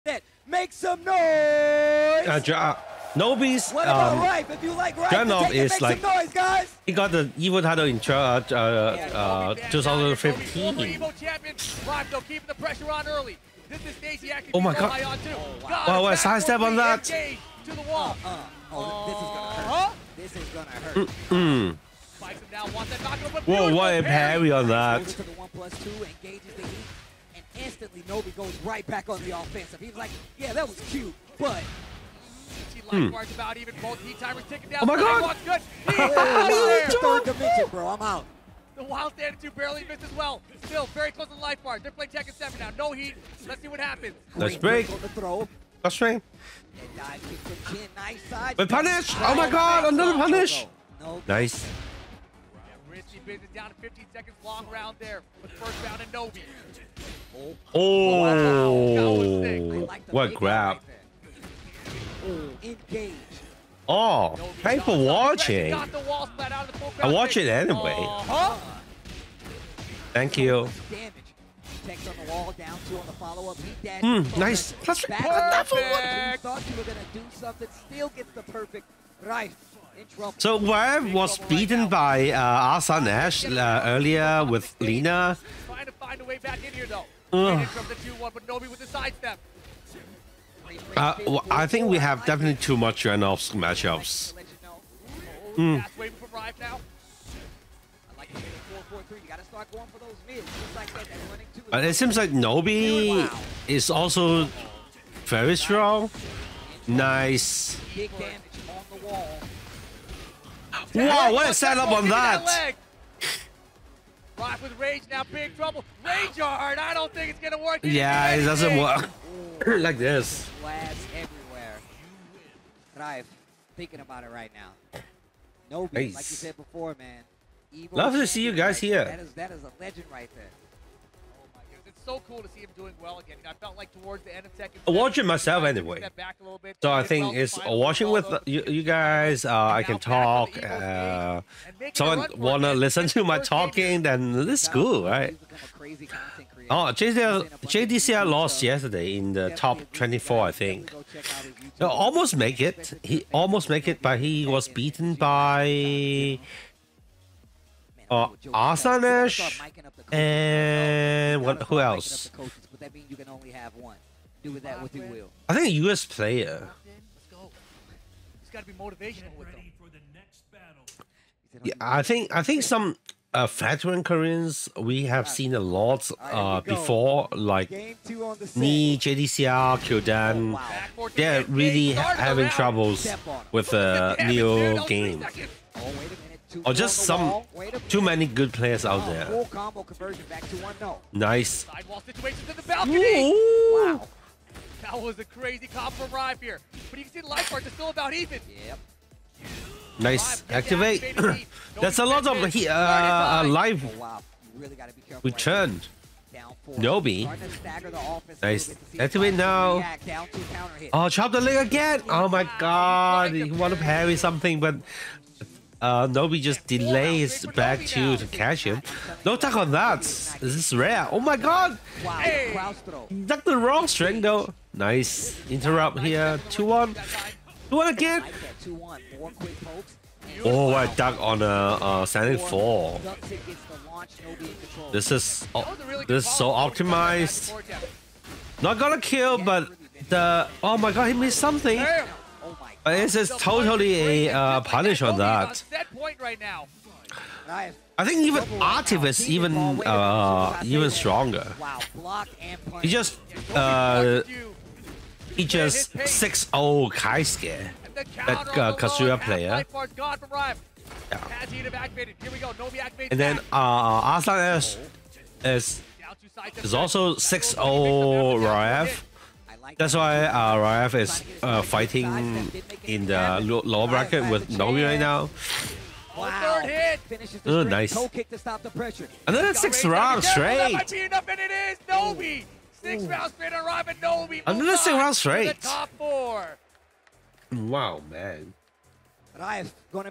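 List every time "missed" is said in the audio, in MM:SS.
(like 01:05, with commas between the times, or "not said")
00:39, 04:01.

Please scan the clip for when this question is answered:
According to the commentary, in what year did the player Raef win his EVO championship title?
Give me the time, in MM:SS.
00:09.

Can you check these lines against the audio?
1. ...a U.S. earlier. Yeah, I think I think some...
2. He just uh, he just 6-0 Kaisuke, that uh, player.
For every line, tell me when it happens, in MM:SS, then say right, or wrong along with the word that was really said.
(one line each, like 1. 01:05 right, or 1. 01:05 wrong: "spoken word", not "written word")
1. 02:45 wrong: "player", not "earlier"
2. 04:12 right.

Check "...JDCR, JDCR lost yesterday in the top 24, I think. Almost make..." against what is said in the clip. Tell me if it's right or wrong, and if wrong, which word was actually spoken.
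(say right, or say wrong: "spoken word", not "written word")
right.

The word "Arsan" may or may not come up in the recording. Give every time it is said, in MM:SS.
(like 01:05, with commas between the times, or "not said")
01:22.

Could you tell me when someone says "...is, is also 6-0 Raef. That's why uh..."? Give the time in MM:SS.
04:25.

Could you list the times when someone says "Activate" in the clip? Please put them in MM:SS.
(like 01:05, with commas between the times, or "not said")
03:20, 03:28.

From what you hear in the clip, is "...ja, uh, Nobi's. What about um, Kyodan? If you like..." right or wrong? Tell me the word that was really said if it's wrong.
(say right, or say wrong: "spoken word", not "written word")
wrong: "Raef", not "Kyodan".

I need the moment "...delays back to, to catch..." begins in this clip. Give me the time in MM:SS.
03:36.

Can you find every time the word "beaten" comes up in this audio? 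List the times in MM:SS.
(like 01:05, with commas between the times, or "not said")
01:21, 02:34.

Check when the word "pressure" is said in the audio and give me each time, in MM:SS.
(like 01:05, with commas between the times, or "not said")
00:12, 04:38.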